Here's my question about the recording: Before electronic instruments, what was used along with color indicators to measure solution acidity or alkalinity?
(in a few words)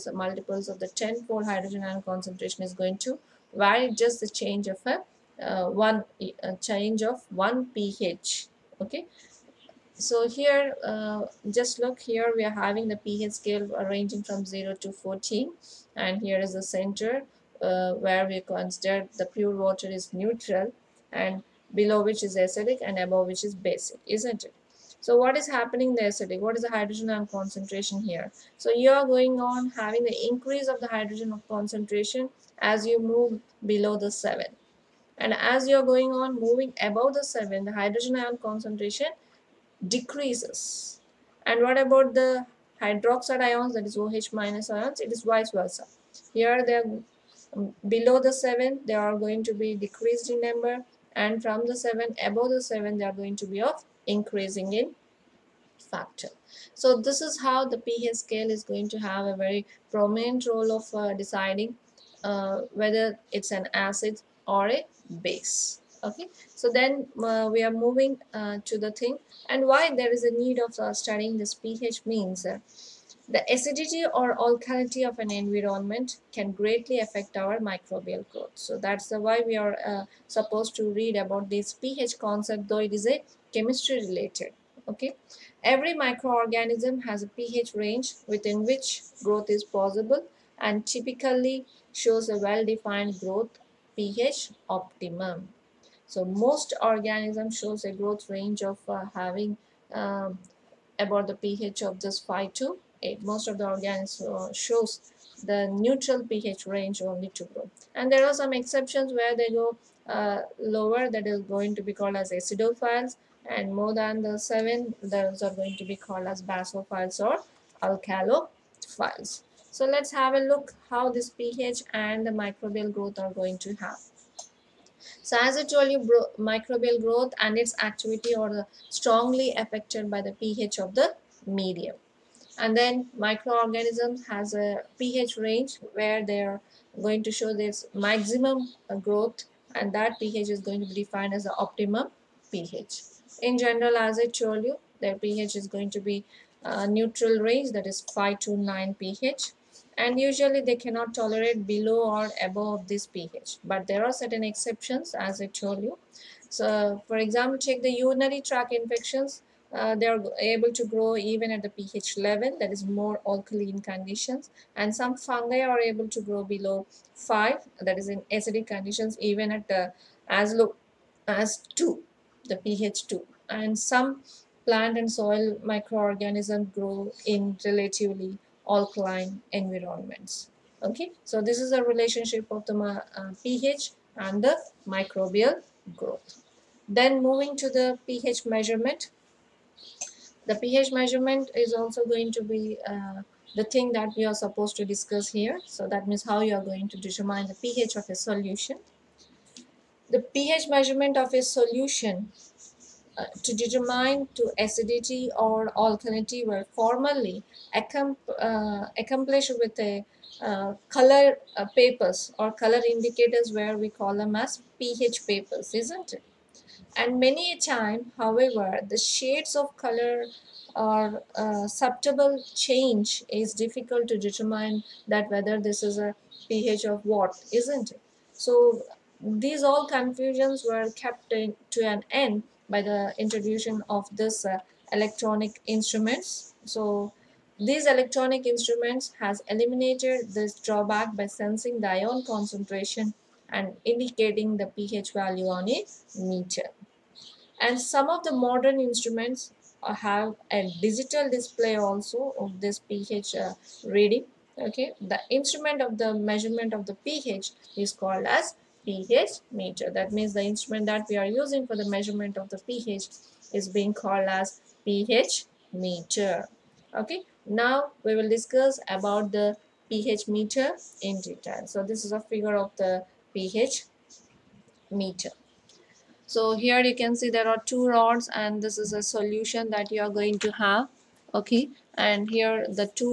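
pH papers.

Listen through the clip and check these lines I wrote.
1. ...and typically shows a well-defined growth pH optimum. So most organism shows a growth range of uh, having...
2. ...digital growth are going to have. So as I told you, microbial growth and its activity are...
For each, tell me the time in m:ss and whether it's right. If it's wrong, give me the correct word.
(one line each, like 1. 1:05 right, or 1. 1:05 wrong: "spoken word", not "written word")
1. 1:30 right
2. 2:02 wrong: "microbial", not "digital".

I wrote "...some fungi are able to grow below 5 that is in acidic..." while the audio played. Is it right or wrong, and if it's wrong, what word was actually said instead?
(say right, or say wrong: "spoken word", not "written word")
right.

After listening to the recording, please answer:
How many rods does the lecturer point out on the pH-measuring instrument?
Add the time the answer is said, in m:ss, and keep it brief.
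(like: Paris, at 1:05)
2, at 4:37.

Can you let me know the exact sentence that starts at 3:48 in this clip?
So these all confusions were kept in, to an end by the introduction of this uh, electronic instruments.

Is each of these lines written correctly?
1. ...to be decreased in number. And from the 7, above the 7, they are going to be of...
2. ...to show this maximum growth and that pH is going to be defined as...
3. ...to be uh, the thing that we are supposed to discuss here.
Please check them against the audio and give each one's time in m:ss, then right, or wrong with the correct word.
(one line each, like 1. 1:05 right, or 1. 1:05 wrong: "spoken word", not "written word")
1. 0:49 right
2. 2:17 right
3. 3:12 right.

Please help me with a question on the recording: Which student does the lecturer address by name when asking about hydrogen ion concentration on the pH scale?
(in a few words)
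Sadiq.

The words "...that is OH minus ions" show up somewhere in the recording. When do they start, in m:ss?
0:43.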